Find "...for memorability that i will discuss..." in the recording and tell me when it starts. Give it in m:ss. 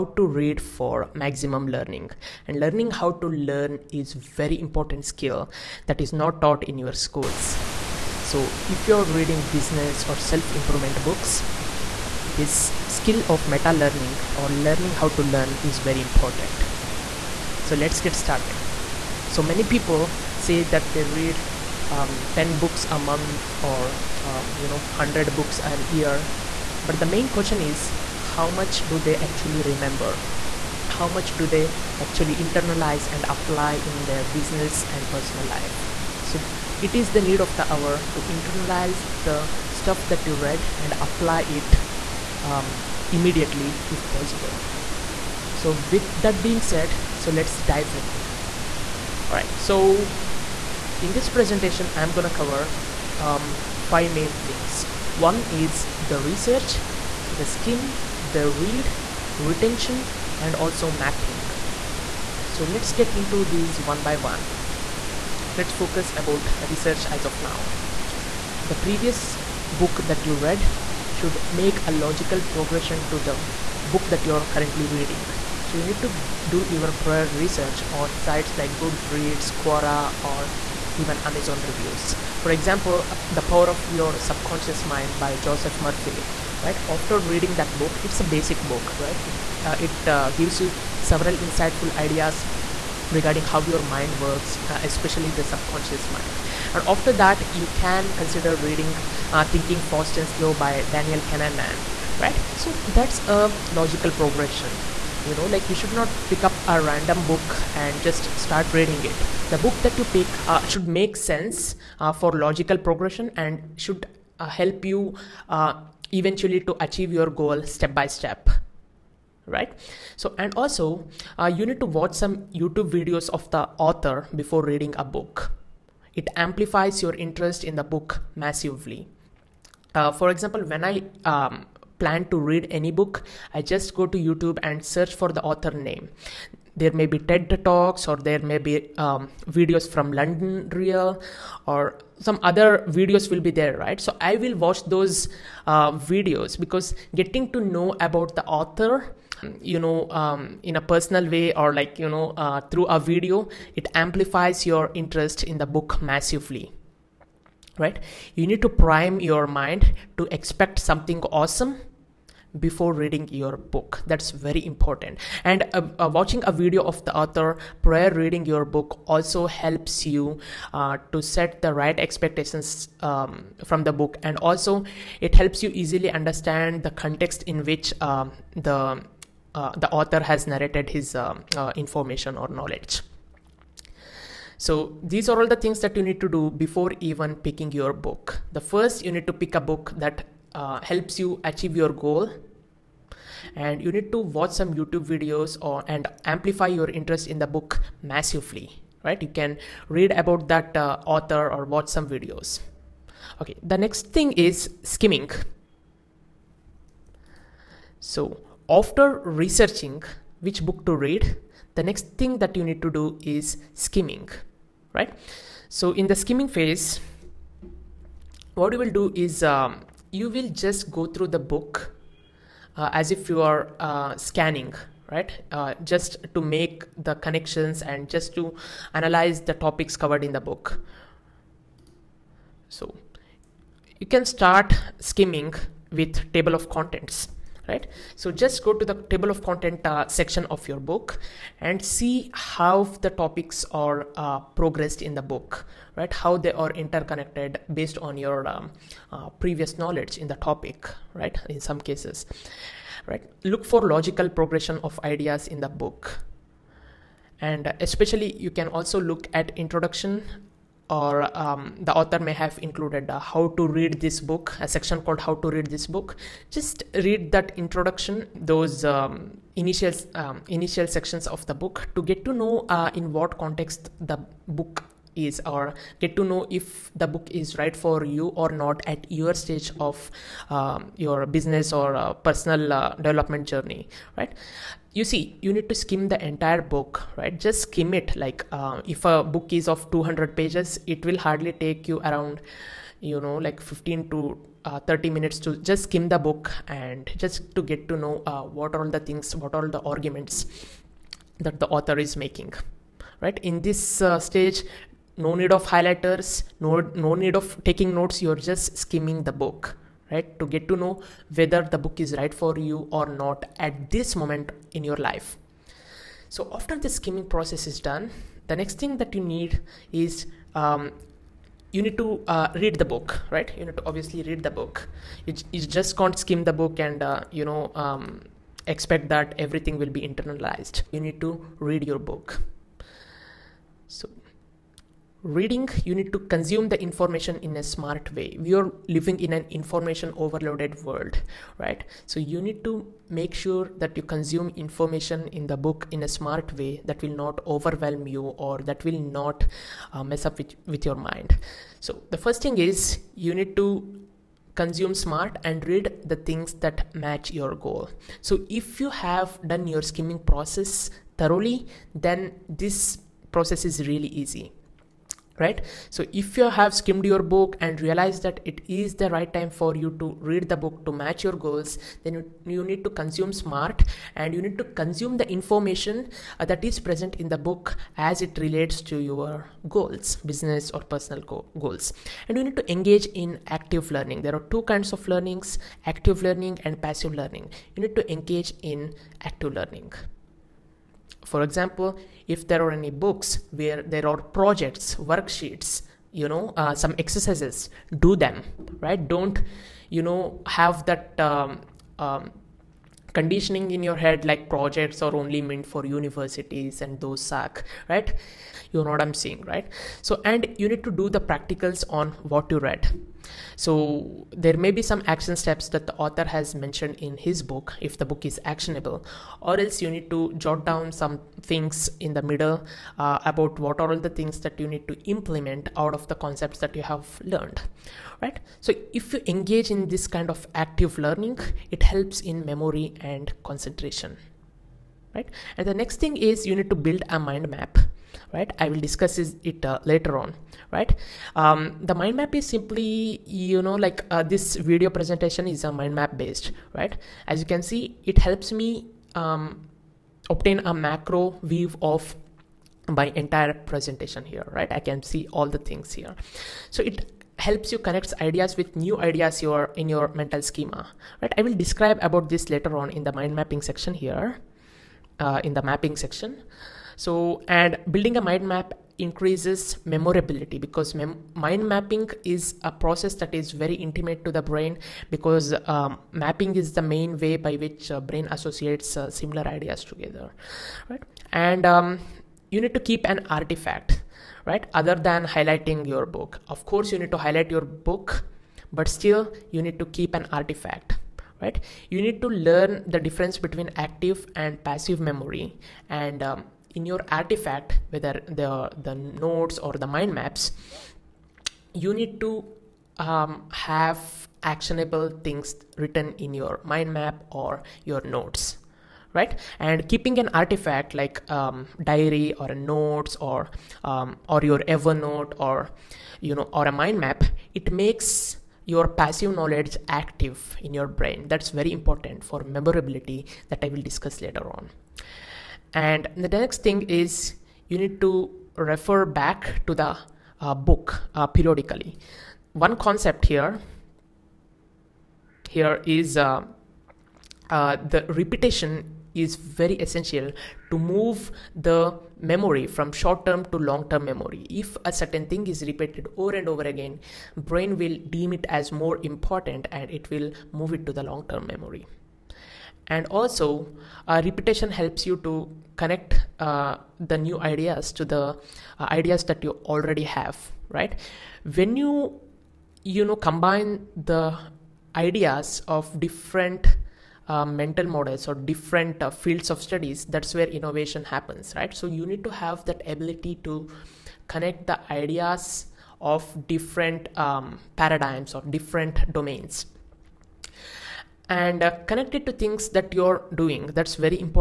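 8:42.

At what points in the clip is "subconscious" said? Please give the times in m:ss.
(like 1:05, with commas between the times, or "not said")
1:24, 1:35.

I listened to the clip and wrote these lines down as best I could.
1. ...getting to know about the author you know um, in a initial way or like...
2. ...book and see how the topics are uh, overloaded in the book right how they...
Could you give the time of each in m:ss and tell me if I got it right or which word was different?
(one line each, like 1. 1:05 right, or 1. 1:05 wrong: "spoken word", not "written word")
1. 2:27 wrong: "personal", not "initial"
2. 4:00 wrong: "progressed", not "overloaded".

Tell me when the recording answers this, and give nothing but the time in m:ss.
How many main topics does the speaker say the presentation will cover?
0:53.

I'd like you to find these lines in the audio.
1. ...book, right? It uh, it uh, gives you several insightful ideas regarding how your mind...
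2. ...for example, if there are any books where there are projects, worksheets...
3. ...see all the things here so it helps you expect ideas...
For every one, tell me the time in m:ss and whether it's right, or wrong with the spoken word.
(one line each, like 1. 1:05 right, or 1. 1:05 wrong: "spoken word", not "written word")
1. 1:28 right
2. 6:31 right
3. 7:35 wrong: "connect", not "expect".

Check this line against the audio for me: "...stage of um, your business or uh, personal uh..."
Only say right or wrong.
right.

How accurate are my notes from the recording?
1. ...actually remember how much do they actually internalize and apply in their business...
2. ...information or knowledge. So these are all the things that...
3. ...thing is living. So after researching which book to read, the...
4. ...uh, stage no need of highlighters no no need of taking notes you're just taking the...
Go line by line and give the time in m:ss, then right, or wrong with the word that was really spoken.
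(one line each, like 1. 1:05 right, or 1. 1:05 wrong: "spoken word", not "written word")
1. 0:29 right
2. 3:01 right
3. 3:24 wrong: "skimming", not "living"
4. 5:04 wrong: "skimming", not "taking".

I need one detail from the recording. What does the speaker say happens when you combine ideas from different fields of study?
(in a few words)
Innovation.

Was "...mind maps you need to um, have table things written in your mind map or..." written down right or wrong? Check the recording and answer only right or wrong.
wrong.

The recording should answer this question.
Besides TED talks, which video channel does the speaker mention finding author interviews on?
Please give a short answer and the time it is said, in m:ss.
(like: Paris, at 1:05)
London Real, at 2:20.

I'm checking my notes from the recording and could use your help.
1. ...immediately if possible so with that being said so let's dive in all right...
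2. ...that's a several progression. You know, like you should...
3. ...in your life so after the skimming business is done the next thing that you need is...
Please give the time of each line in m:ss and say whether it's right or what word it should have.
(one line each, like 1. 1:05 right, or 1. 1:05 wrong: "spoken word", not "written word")
1. 0:43 right
2. 1:42 wrong: "logical", not "several"
3. 5:14 wrong: "process", not "business".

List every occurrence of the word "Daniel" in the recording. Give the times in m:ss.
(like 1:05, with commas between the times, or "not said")
1:40.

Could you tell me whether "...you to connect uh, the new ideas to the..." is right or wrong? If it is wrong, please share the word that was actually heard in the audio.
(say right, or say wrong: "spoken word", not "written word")
right.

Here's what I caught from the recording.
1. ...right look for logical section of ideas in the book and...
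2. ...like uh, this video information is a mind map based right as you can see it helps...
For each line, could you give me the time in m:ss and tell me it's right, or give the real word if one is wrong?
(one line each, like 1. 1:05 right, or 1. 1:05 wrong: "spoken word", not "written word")
1. 4:13 wrong: "progression", not "section"
2. 7:23 wrong: "presentation", not "information".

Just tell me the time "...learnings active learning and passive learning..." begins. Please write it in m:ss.
6:25.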